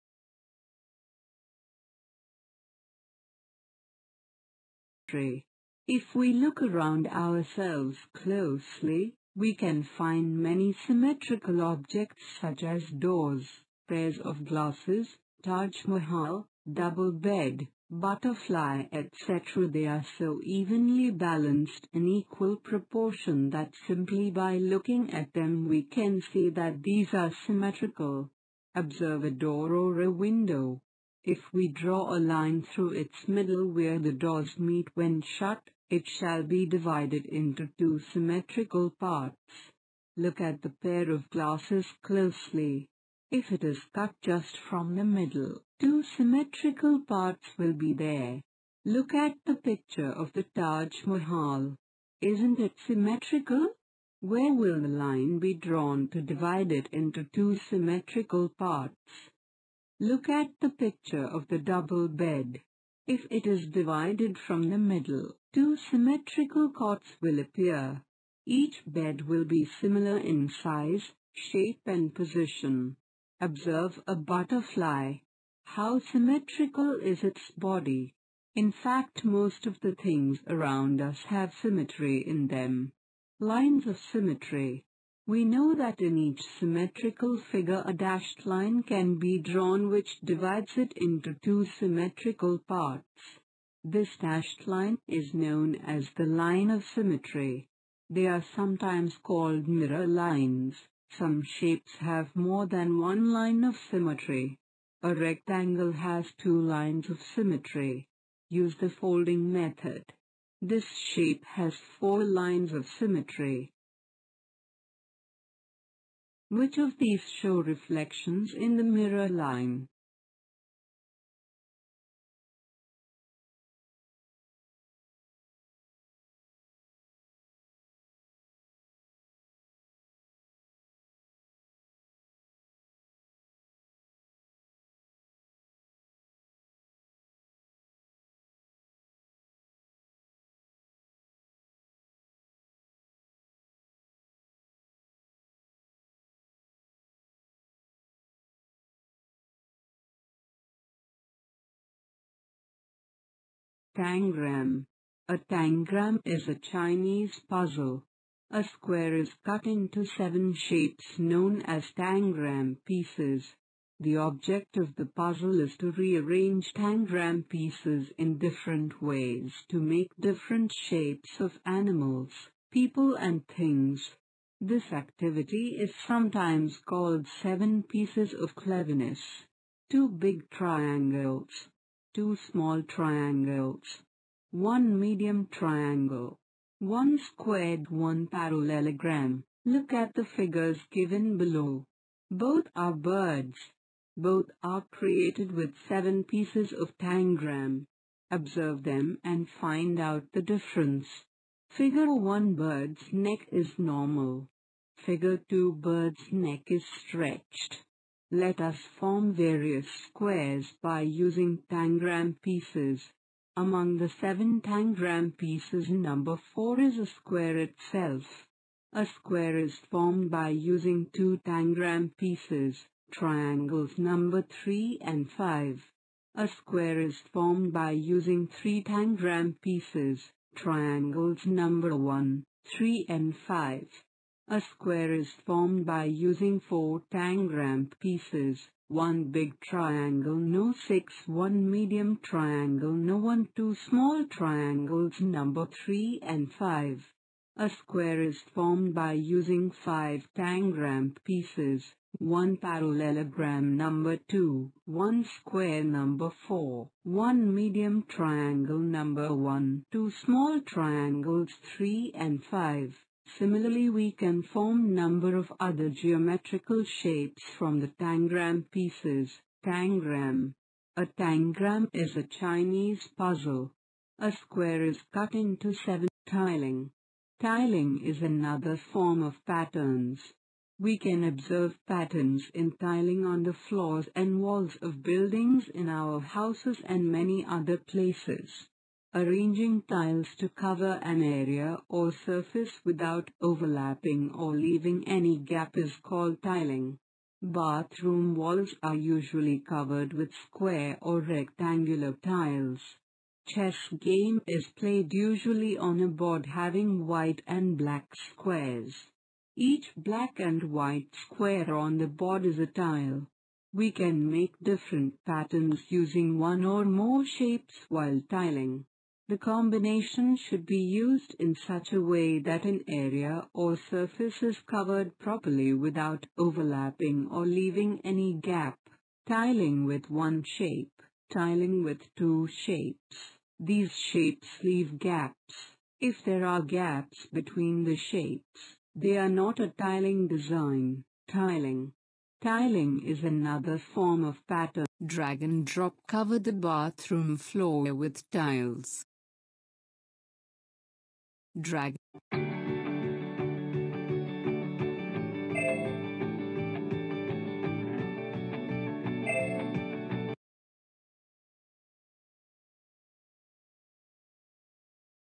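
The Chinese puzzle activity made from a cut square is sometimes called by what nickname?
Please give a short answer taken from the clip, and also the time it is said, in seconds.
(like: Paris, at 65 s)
seven pieces of cleverness, at 177 s.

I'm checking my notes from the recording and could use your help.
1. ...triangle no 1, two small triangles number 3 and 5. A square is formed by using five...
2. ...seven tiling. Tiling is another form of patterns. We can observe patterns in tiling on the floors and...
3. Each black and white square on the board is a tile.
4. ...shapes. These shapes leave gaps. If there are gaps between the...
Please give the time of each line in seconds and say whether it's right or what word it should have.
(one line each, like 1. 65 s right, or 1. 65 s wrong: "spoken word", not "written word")
1. 242 s right
2. 275 s right
3. 309 s right
4. 332 s right.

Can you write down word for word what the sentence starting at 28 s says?
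Observe a door or a window.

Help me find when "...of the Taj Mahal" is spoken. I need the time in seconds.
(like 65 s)
50 s.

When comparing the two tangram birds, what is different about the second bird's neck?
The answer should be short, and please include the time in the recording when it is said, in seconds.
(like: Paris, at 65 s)
stretched, at 206 s.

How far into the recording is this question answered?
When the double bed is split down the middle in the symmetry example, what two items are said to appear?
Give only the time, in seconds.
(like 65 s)
65 s.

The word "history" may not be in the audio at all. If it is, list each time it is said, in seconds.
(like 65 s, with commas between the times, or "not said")
5 s.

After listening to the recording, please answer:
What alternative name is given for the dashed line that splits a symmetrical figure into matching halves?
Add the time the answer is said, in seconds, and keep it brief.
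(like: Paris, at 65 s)
mirror lines, at 99 s.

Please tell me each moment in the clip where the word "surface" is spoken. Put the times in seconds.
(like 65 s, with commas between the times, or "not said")
292 s, 323 s.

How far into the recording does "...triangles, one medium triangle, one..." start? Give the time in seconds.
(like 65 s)
182 s.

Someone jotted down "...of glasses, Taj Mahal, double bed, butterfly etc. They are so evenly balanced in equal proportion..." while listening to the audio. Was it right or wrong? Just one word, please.
right.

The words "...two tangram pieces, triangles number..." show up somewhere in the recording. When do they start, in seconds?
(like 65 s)
221 s.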